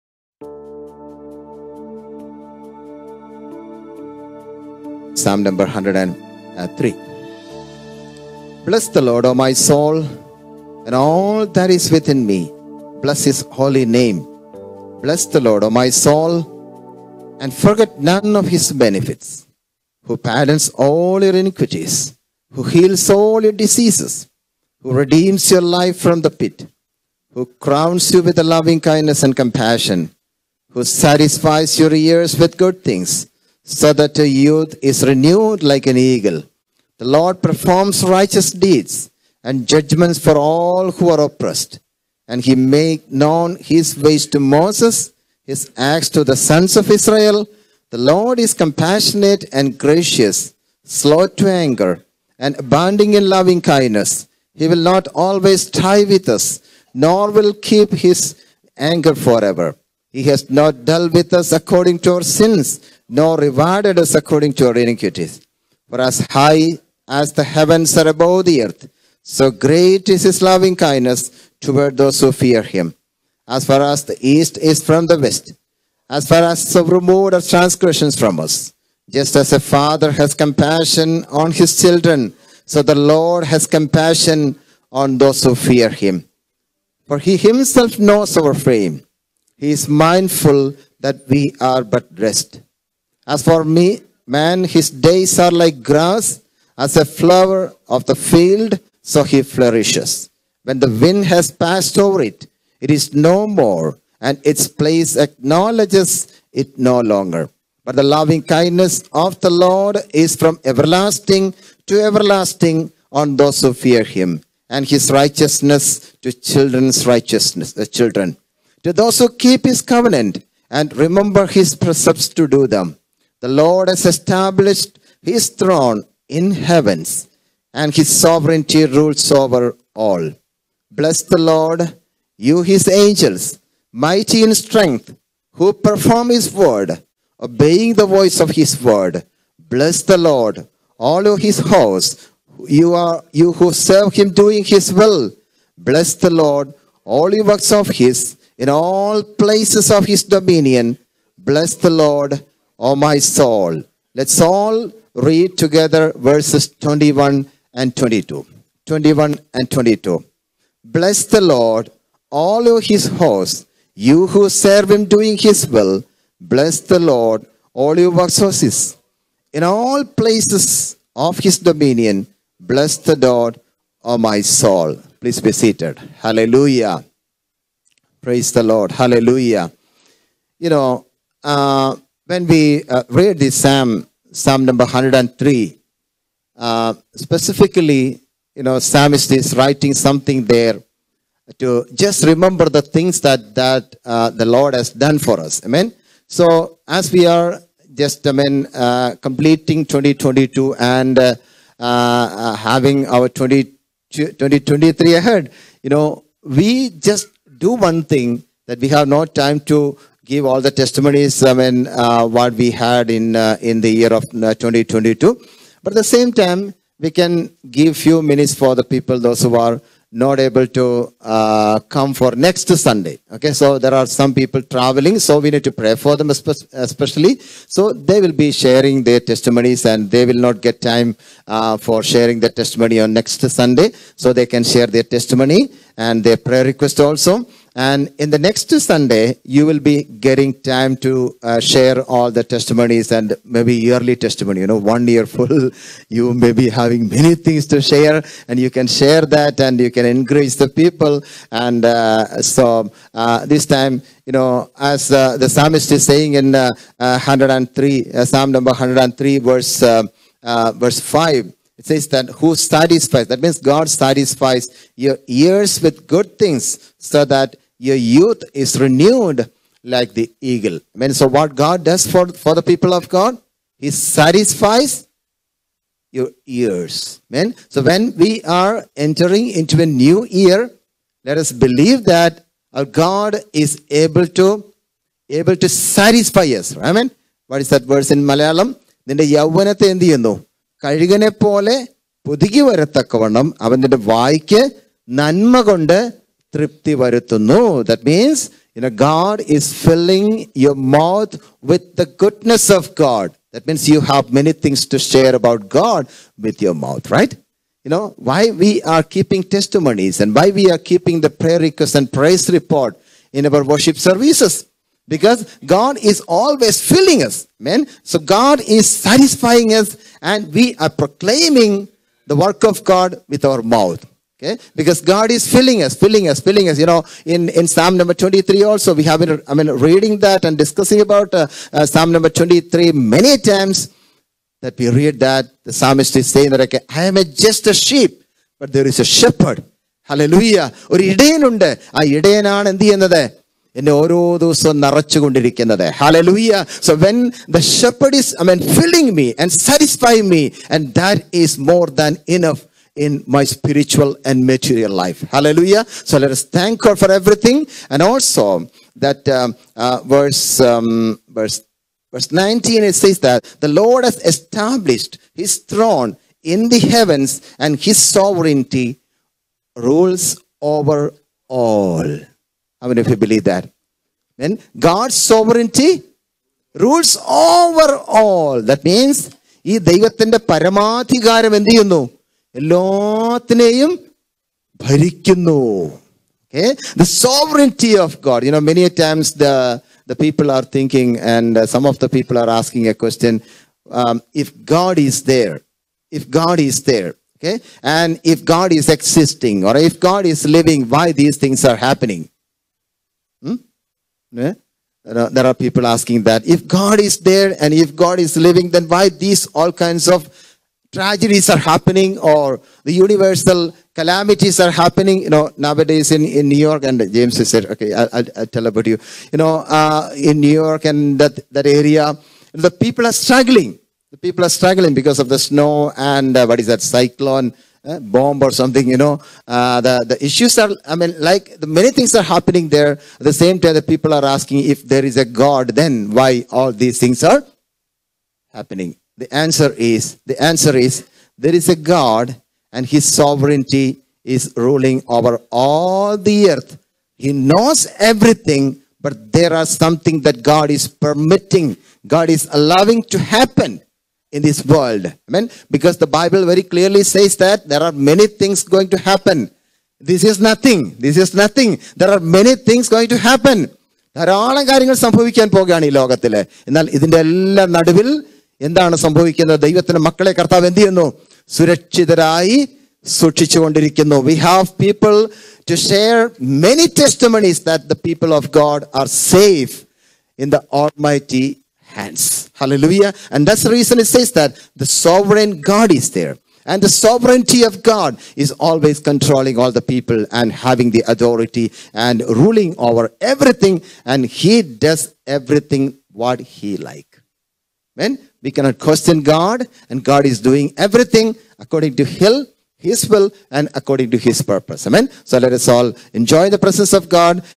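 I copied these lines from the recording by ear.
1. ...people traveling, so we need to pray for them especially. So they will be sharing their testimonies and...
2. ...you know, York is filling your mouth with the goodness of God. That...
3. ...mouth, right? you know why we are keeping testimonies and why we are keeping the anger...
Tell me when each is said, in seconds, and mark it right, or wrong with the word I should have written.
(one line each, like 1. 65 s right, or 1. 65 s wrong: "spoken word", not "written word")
1. 224 s right
2. 298 s wrong: "God", not "York"
3. 306 s wrong: "prayer", not "anger".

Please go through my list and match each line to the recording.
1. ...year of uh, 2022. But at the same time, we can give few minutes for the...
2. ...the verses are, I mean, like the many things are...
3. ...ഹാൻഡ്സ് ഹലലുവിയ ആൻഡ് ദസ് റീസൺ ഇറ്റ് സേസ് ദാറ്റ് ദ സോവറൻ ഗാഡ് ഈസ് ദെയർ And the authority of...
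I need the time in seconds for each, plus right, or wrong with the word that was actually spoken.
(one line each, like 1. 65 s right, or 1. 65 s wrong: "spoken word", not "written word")
1. 213 s right
2. 430 s wrong: "issues", not "verses"
3. 481 s wrong: "sovereignty", not "authority".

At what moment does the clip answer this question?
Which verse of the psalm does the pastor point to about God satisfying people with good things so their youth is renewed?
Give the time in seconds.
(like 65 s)
260 s.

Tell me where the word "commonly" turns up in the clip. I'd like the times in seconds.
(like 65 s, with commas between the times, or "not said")
not said.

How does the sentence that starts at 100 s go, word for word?
When the wind has passed over it, it is no more, and its place acknowledges it no longer.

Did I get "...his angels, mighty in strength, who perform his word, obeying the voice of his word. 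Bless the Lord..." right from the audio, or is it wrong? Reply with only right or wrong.
right.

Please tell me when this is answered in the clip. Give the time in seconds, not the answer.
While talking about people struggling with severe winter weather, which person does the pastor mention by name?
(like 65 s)
417 s.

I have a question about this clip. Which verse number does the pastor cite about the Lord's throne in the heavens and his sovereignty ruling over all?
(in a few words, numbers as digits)
Verse 19.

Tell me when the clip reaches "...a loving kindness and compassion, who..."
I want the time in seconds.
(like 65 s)
28 s.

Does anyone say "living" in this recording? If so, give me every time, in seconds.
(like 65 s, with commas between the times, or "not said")
400 s, 408 s.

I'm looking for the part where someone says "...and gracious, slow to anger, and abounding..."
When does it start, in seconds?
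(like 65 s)
49 s.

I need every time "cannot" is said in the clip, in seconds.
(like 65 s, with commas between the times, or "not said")
498 s.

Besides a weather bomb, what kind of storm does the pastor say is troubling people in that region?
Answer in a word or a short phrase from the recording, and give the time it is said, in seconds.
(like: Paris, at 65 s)
Cyclone, at 426 s.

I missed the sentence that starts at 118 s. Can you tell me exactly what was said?
To those who keep his covenant and remember his precepts to do them.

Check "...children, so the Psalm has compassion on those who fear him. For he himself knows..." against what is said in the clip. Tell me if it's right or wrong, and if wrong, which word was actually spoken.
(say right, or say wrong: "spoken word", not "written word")
wrong: "Lord", not "Psalm".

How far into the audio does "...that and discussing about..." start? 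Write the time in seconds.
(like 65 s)
330 s.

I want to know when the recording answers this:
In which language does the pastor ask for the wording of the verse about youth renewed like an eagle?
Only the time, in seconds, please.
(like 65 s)
288 s.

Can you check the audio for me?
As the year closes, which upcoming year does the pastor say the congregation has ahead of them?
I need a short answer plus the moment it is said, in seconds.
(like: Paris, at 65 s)
2023, at 204 s.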